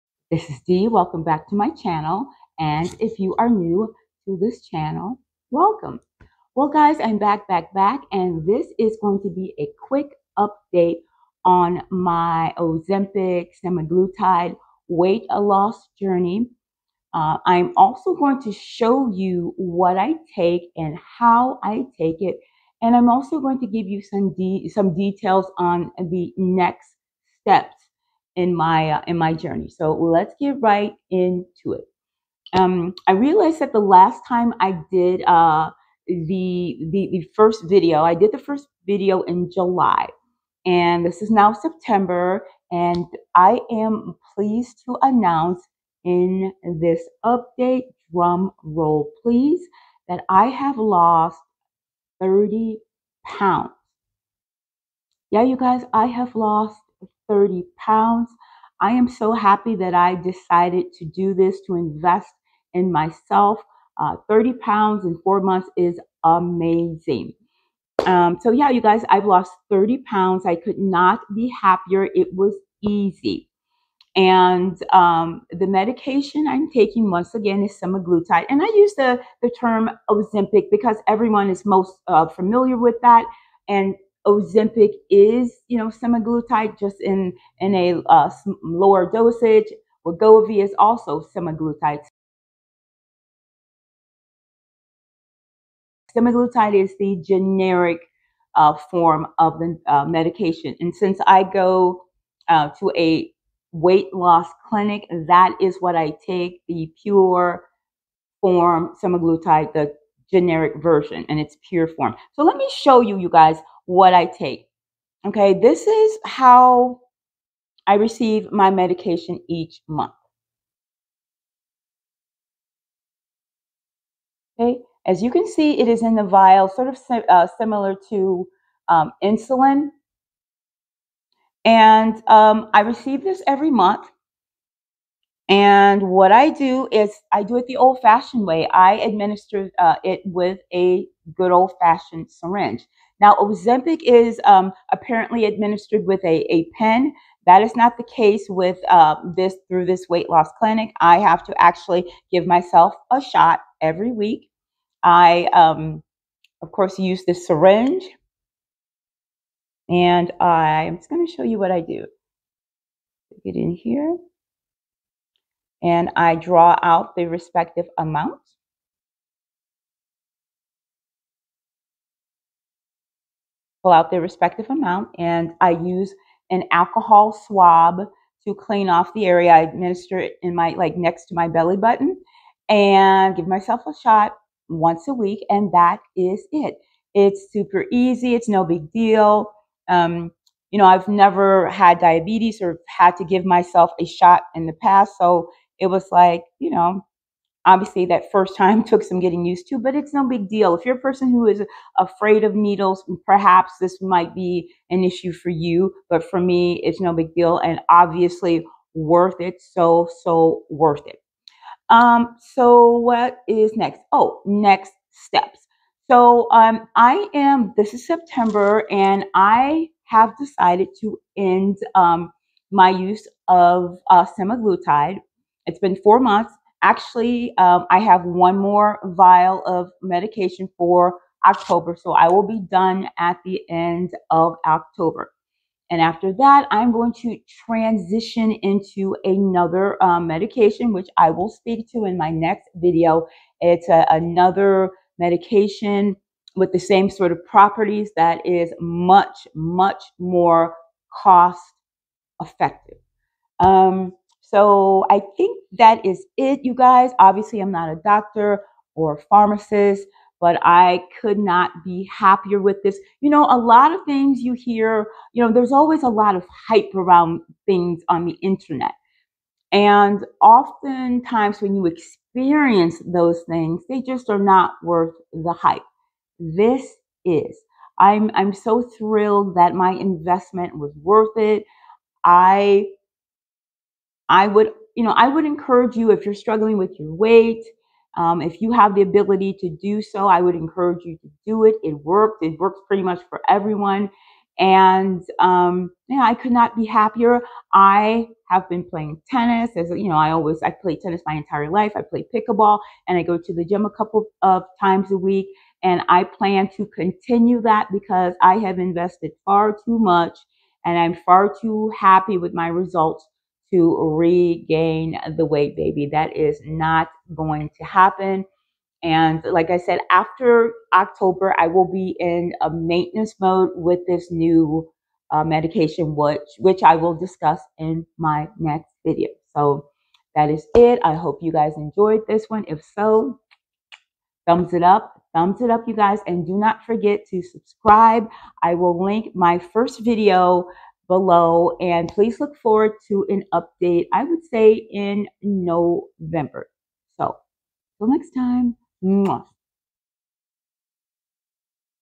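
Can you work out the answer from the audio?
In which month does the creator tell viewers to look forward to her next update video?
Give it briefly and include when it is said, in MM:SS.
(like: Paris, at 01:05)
November, at 05:45.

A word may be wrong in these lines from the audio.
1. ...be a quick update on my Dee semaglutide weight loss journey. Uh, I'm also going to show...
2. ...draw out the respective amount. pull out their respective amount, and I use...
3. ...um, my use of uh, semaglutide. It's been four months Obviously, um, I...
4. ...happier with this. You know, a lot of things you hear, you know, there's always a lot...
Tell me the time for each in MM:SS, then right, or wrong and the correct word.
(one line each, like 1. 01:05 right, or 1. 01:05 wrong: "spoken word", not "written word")
1. 00:09 wrong: "Ozempic", not "Dee"
2. 02:46 right
3. 03:41 wrong: "Actually", not "Obviously"
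4. 04:22 right.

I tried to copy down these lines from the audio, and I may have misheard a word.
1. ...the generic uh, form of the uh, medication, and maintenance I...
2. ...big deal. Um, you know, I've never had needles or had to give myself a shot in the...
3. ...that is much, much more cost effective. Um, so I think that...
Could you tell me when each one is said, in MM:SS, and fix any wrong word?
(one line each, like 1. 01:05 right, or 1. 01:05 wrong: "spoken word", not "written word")
1. 01:36 wrong: "since", not "maintenance"
2. 03:08 wrong: "diabetes", not "needles"
3. 04:08 right.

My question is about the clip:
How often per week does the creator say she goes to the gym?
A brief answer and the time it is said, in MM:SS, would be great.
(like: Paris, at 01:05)
A couple of times, at 05:03.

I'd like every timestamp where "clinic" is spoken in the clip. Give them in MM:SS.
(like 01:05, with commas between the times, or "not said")
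01:44, 02:30.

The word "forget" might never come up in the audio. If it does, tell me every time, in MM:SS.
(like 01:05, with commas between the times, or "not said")
05:36.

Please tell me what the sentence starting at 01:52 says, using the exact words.
So let me show you, you guys, what I take.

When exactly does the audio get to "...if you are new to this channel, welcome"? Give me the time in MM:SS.
00:03.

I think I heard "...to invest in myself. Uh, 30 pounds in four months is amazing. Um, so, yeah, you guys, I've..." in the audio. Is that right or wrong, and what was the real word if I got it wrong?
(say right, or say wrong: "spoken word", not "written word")
right.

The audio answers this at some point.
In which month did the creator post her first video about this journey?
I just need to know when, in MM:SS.
00:39.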